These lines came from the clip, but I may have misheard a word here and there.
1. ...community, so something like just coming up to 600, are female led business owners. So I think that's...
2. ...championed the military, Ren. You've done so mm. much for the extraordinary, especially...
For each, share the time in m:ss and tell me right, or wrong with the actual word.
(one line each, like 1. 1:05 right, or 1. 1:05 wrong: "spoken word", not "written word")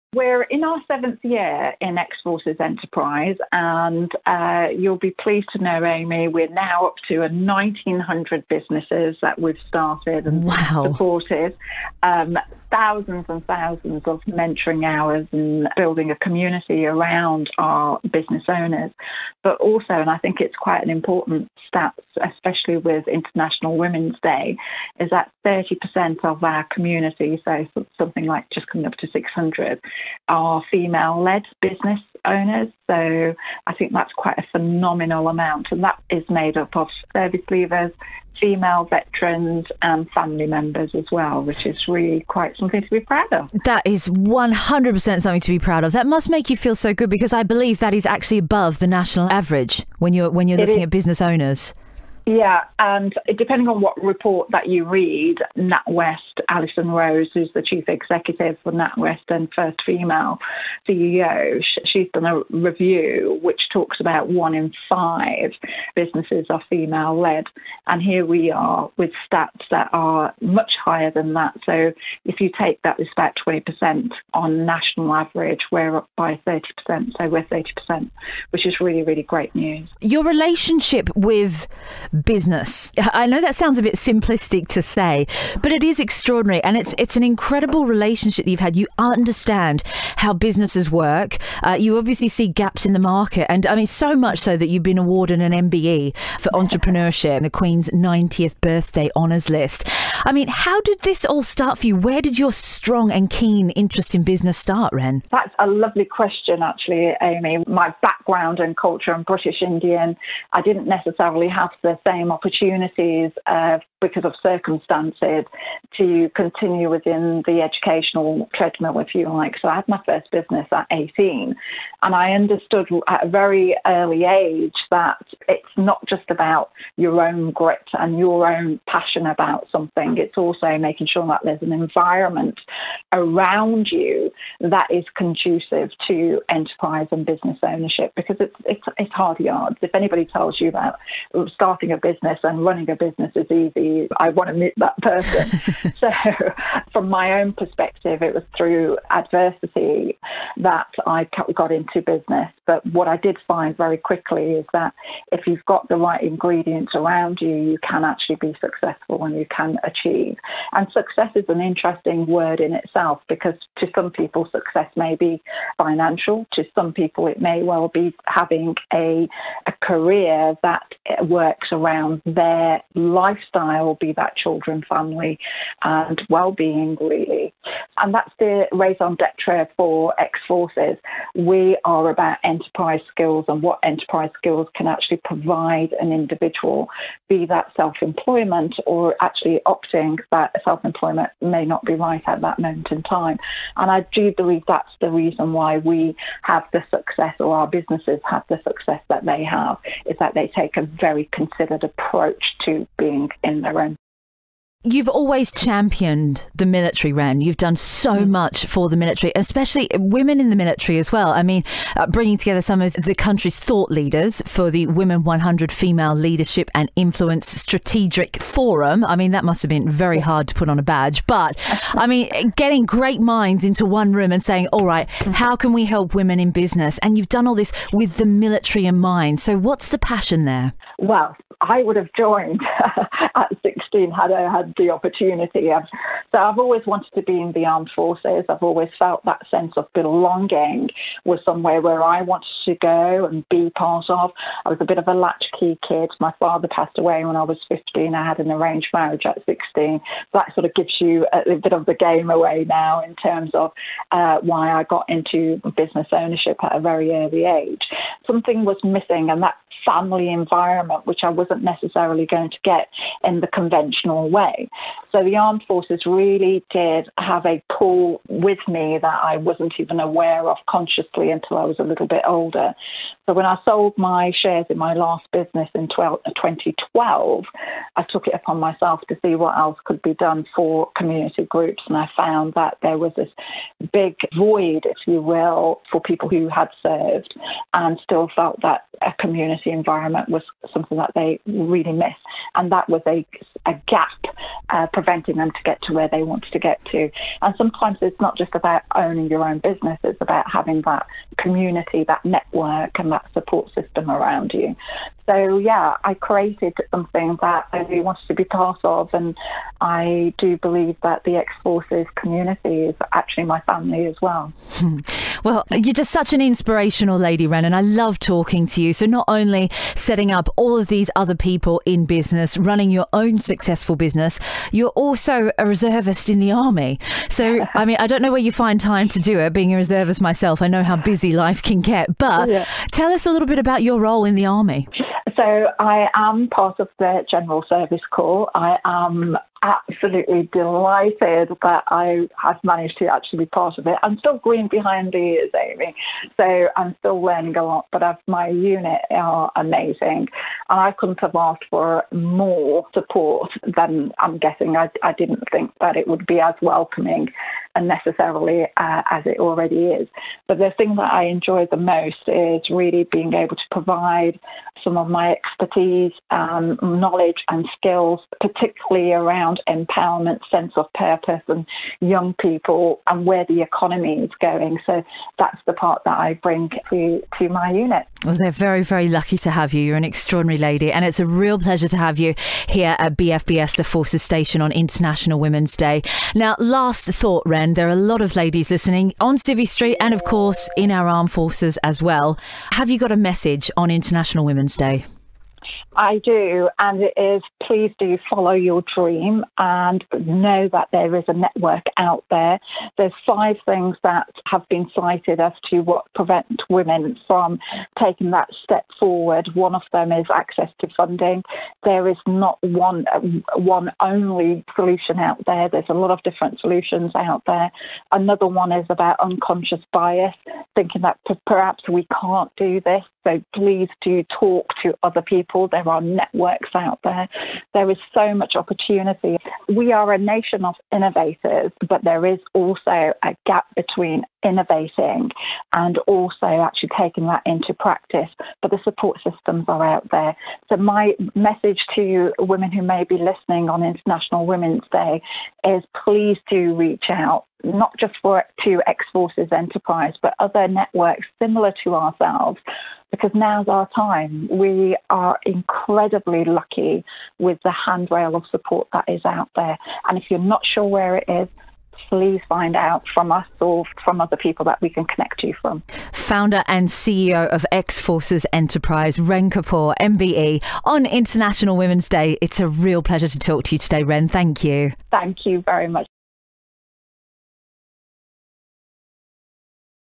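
1. 0:26 right
2. 3:25 wrong: "military", not "extraordinary".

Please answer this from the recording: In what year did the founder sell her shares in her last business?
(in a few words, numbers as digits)
2012.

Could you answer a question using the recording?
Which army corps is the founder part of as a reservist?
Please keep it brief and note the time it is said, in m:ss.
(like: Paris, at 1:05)
General Service Corps, at 5:37.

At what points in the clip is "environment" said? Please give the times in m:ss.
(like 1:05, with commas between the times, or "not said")
2:11, 4:20, 4:49.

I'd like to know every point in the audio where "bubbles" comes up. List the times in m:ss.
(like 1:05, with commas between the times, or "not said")
not said.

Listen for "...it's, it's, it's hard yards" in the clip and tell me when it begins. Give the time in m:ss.
2:18.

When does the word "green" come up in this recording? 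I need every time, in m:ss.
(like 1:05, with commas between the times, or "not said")
5:44.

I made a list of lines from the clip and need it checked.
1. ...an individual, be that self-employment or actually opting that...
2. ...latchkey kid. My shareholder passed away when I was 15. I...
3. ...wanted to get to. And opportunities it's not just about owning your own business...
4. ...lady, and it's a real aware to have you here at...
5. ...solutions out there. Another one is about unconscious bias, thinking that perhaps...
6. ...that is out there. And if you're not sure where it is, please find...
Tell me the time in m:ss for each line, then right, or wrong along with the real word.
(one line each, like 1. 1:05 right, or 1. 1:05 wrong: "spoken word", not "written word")
1. 3:05 right
2. 4:05 wrong: "father", not "shareholder"
3. 4:56 wrong: "sometimes", not "opportunities"
4. 6:20 wrong: "pleasure", not "aware"
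5. 6:56 right
6. 7:38 right.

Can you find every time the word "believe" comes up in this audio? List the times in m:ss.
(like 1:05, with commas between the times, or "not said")
0:47, 3:14, 5:10.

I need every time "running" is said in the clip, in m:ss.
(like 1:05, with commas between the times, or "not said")
2:22, 5:22.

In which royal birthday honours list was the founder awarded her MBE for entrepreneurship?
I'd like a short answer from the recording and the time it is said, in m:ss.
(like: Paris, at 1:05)
Queen's 90th birthday honours, at 1:37.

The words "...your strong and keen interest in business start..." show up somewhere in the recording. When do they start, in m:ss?
1:42.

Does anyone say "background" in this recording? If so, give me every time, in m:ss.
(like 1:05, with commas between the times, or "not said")
1:48.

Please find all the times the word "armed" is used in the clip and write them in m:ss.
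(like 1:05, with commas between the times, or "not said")
3:57, 4:25, 6:31.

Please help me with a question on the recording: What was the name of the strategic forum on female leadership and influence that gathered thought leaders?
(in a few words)
Women 100.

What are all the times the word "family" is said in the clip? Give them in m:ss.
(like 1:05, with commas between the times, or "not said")
0:40, 2:54, 4:19, 5:13.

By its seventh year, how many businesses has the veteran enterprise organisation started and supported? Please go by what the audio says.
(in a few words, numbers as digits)
1,900.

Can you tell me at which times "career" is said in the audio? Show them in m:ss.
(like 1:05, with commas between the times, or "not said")
2:49.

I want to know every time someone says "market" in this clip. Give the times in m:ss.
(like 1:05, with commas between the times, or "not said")
1:32.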